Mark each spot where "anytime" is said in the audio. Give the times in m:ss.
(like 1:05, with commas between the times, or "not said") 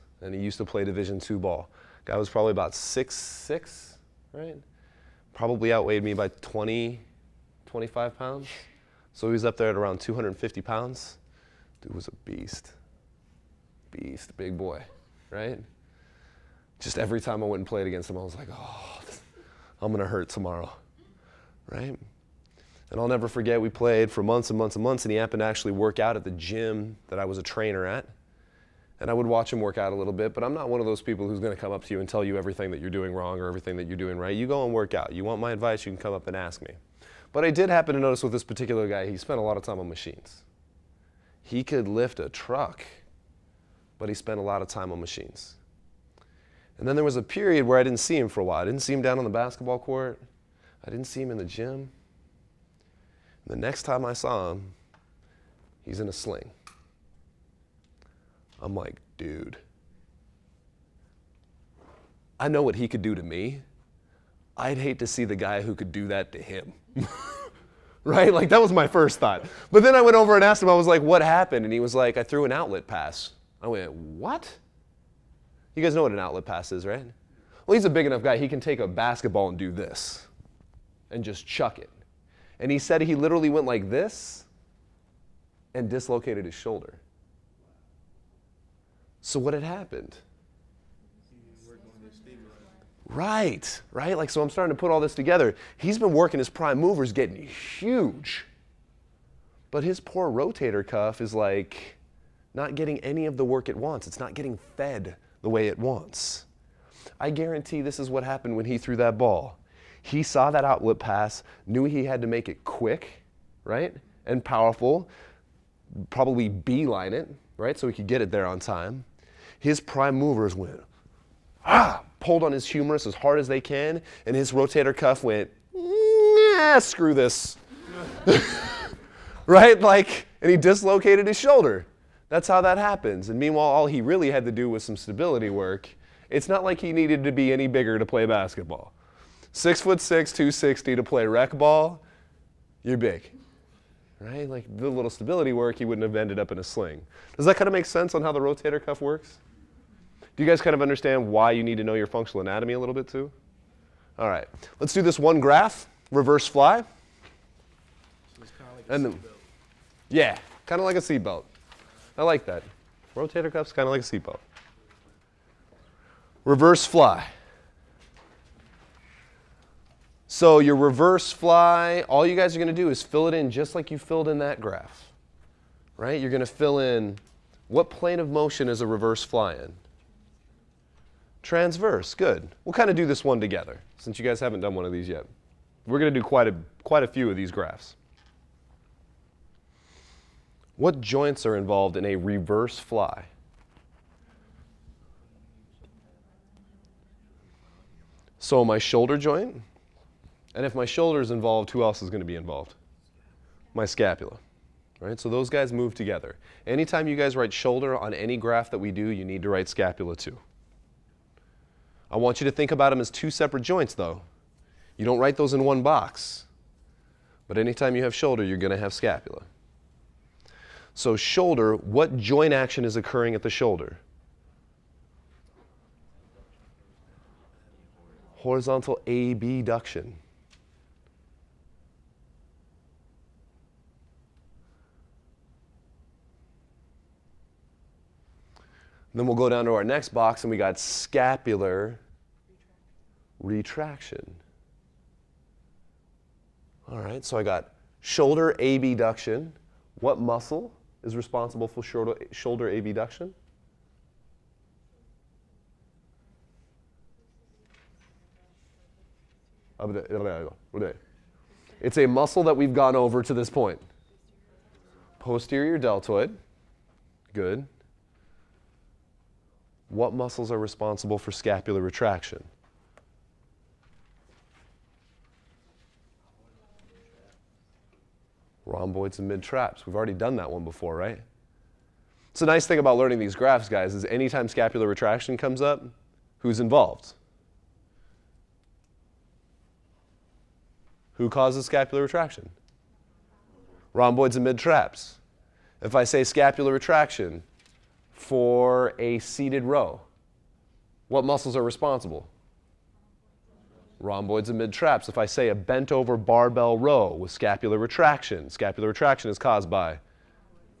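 3:26, 3:37, 4:44.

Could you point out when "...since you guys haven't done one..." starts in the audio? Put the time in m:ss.
3:03.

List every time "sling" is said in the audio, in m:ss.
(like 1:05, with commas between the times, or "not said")
0:56, 2:26.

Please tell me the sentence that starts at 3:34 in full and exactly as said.
You don't write those in one box.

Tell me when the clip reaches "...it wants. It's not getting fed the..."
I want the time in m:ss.
1:43.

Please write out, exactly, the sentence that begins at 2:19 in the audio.
Six foot six, 260 to play rec ball, you're big.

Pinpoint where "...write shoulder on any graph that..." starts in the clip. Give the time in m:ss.
3:27.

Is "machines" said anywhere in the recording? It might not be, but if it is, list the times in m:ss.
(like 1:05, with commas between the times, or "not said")
0:39, 0:45.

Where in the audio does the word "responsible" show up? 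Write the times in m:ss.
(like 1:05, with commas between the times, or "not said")
4:11, 4:30, 5:01.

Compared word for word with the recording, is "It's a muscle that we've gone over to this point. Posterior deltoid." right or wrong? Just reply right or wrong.
right.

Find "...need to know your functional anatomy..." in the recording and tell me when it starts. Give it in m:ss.
2:31.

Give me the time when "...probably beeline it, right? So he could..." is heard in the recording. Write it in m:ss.
1:56.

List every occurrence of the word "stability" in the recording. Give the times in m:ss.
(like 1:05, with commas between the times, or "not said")
2:14, 2:25.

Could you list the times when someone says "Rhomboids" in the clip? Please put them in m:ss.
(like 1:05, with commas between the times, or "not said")
4:38, 4:53, 5:03.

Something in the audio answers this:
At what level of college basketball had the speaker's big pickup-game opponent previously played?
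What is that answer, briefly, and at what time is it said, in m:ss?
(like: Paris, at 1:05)
Division two, at 0:00.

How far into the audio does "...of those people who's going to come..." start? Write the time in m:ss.
0:30.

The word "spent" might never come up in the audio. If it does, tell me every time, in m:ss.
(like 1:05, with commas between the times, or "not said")
0:39, 0:44.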